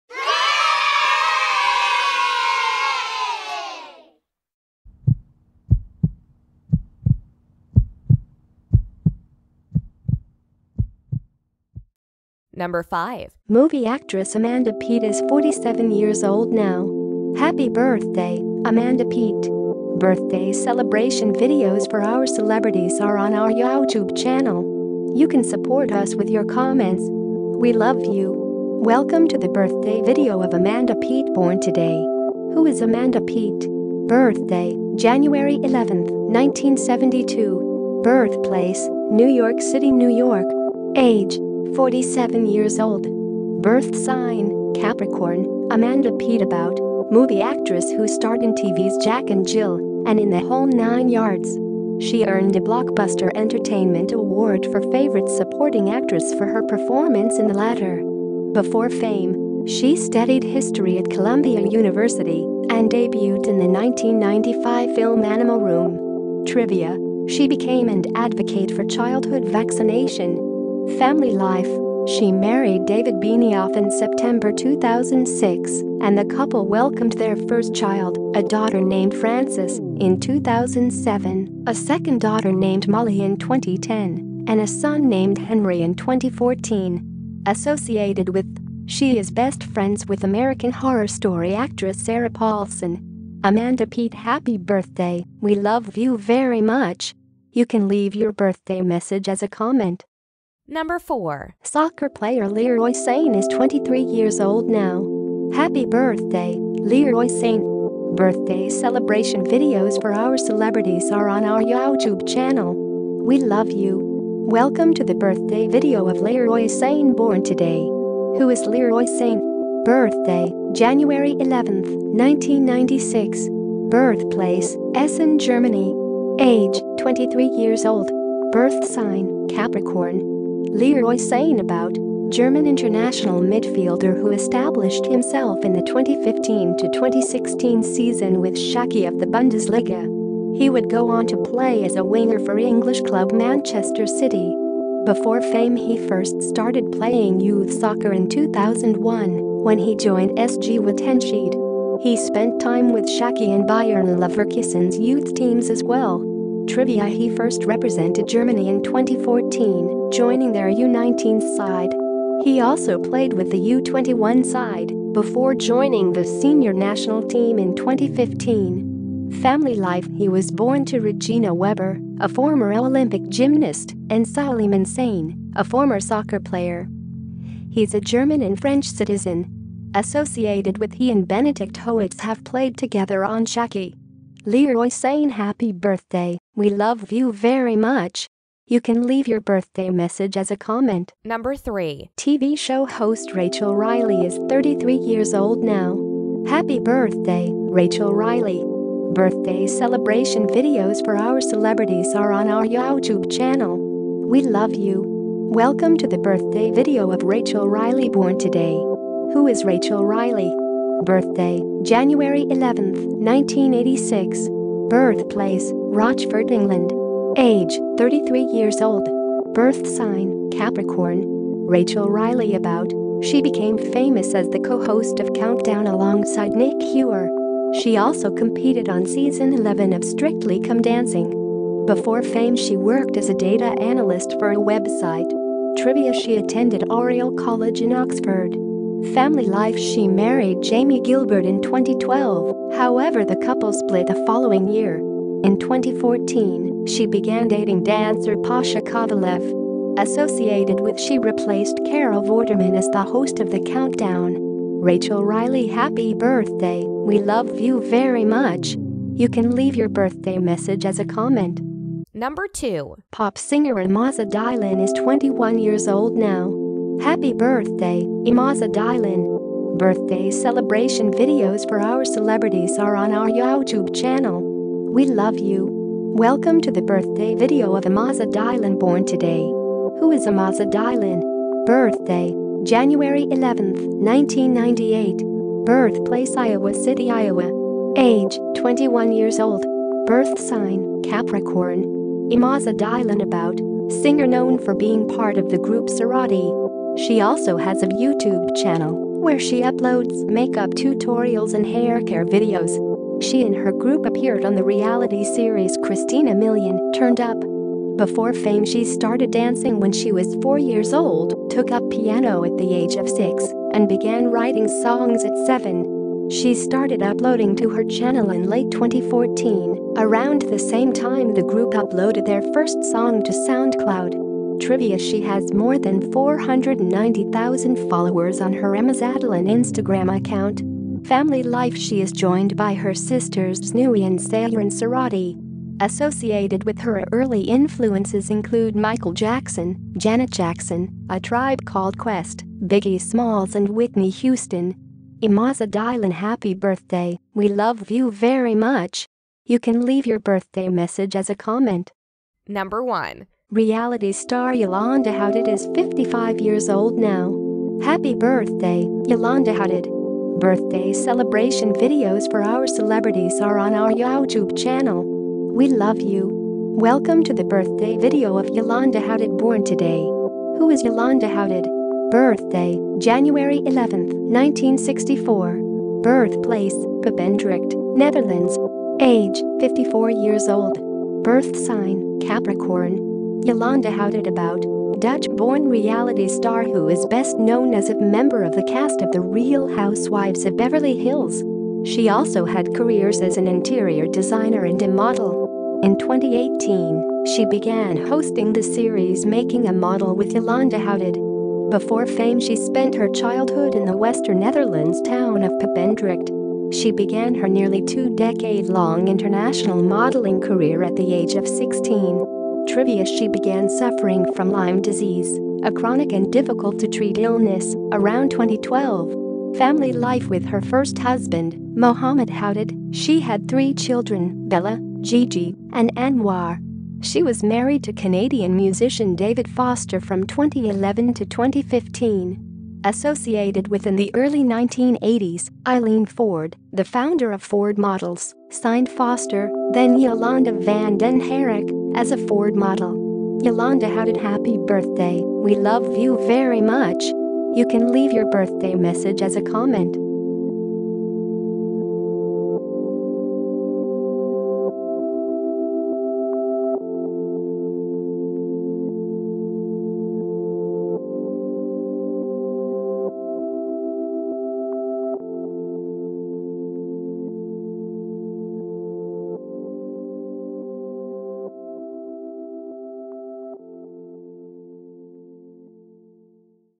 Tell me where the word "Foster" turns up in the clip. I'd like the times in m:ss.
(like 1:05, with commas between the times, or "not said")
7:09, 7:18.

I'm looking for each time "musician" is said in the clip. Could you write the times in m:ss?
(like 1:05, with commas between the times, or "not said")
7:08.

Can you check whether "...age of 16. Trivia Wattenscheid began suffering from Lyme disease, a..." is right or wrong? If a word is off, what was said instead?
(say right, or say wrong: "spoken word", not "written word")
wrong: "She", not "Wattenscheid".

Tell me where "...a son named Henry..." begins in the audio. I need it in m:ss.
1:24.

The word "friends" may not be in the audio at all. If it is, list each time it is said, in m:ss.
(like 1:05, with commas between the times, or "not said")
1:29.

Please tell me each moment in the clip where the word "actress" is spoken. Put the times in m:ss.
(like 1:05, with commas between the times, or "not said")
0:13, 0:47, 0:55, 1:31.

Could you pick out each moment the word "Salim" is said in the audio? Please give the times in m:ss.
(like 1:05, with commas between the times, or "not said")
2:54.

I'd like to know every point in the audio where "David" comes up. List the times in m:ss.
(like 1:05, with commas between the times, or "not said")
1:12, 7:09.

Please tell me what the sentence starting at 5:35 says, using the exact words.
Associated with her early influences include Michael Jackson, Janet Jackson, A Tribe Called Quest, Biggie Smalls and Whitney Houston.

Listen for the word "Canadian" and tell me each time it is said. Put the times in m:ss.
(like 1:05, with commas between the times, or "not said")
7:07.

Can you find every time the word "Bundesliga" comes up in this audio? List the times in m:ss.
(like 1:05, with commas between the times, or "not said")
2:19.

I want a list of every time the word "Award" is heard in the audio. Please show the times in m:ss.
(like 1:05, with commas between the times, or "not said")
0:54.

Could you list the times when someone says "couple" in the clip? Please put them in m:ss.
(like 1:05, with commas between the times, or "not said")
1:16, 4:03.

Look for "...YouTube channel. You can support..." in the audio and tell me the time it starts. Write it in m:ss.
0:23.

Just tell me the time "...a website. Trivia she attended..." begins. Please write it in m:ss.
3:54.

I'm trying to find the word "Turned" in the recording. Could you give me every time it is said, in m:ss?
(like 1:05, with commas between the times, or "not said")
5:06.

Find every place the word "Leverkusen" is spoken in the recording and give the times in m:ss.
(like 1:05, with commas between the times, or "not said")
2:34.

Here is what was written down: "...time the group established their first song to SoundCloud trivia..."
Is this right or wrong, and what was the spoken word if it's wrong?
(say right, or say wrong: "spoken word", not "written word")
wrong: "uploaded", not "established".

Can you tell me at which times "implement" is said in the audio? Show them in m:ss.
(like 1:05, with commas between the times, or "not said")
not said.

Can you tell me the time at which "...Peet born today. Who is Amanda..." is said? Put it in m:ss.
0:30.